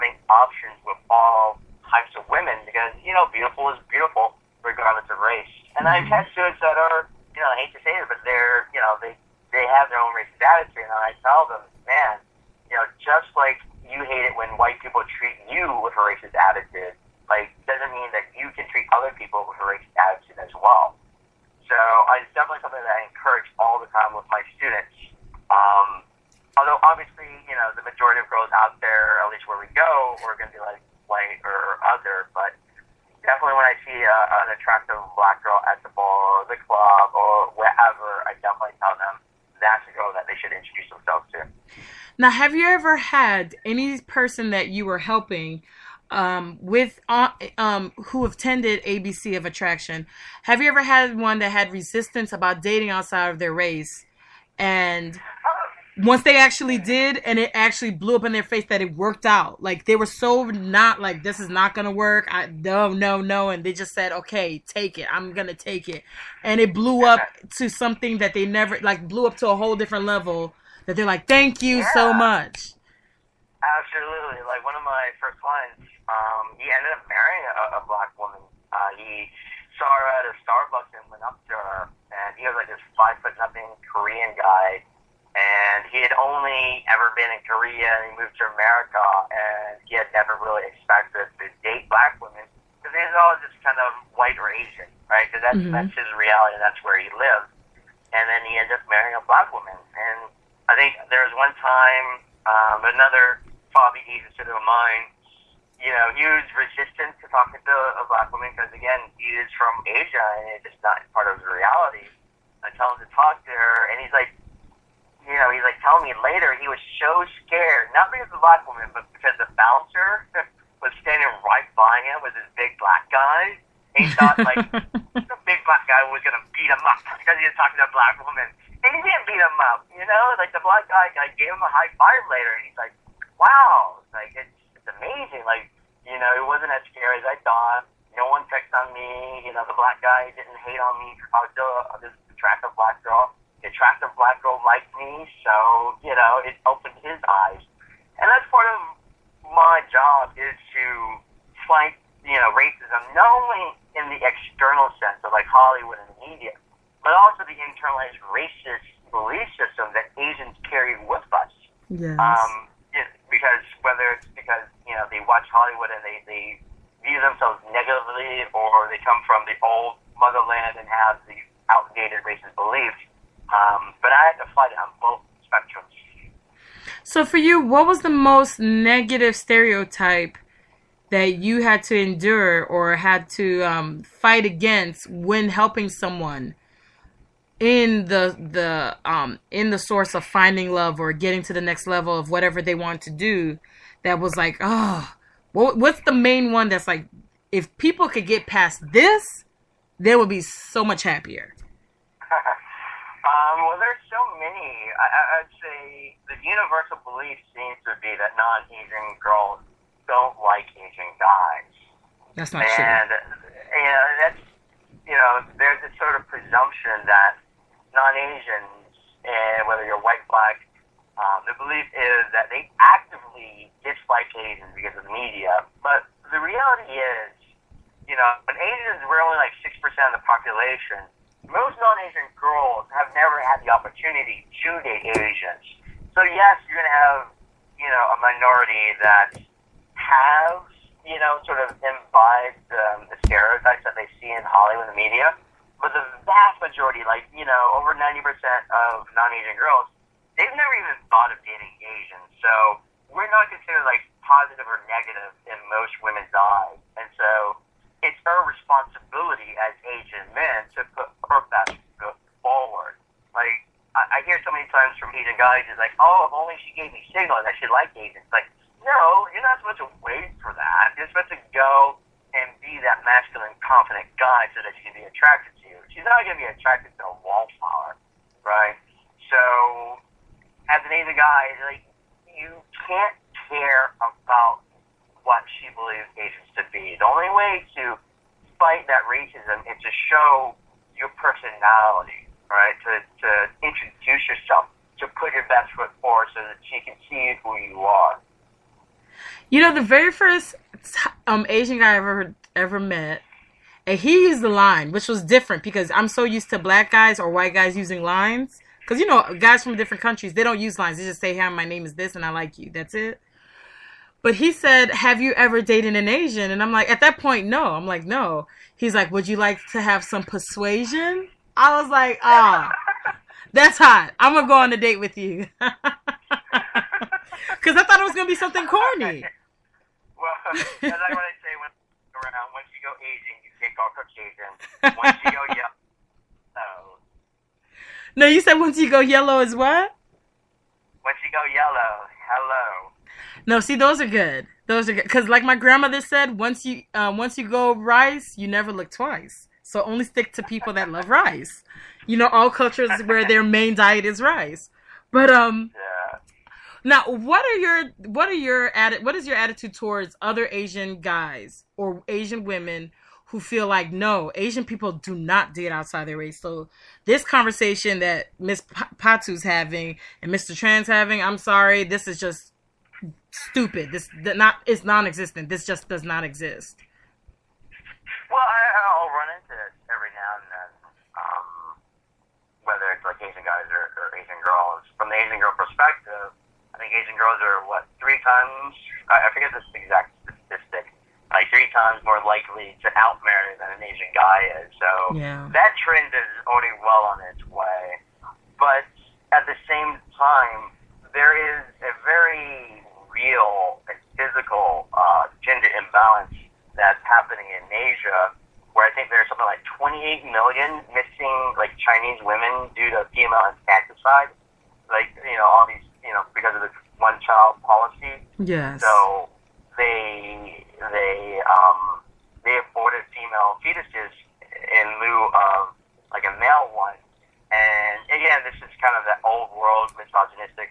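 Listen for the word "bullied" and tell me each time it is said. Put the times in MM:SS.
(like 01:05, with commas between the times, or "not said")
not said.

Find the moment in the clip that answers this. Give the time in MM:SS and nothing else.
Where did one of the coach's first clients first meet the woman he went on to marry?
01:20.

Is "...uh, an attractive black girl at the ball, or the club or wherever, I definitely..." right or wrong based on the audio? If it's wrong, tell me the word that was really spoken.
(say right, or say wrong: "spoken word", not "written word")
right.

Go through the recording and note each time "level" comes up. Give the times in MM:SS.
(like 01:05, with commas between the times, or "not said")
01:10, 03:11.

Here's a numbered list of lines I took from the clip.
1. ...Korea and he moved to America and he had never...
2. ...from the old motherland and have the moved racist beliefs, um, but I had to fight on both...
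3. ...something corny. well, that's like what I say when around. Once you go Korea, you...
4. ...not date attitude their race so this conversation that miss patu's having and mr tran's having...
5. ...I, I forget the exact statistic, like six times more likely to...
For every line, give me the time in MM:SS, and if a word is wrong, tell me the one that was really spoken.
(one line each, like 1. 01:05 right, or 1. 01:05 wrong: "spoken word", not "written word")
1. 01:27 right
2. 02:49 wrong: "outdated", not "moved"
3. 05:28 wrong: "Asian", not "Korea"
4. 06:05 wrong: "outside", not "attitude"
5. 06:29 wrong: "three", not "six".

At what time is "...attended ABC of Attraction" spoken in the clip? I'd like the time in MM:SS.
00:48.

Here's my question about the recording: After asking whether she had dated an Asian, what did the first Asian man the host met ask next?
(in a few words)
Would you like to have some persuasion?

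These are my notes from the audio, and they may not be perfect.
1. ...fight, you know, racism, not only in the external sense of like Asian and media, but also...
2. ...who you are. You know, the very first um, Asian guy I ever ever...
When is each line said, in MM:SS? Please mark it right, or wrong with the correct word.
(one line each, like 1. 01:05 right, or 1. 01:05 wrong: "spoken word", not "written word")
1. 02:31 wrong: "Hollywood", not "Asian"
2. 04:57 right.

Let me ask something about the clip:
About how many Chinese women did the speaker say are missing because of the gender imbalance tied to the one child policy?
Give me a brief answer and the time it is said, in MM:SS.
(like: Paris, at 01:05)
28 million, at 06:49.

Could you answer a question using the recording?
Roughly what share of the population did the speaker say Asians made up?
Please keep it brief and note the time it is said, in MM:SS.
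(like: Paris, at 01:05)
6 percent, at 03:49.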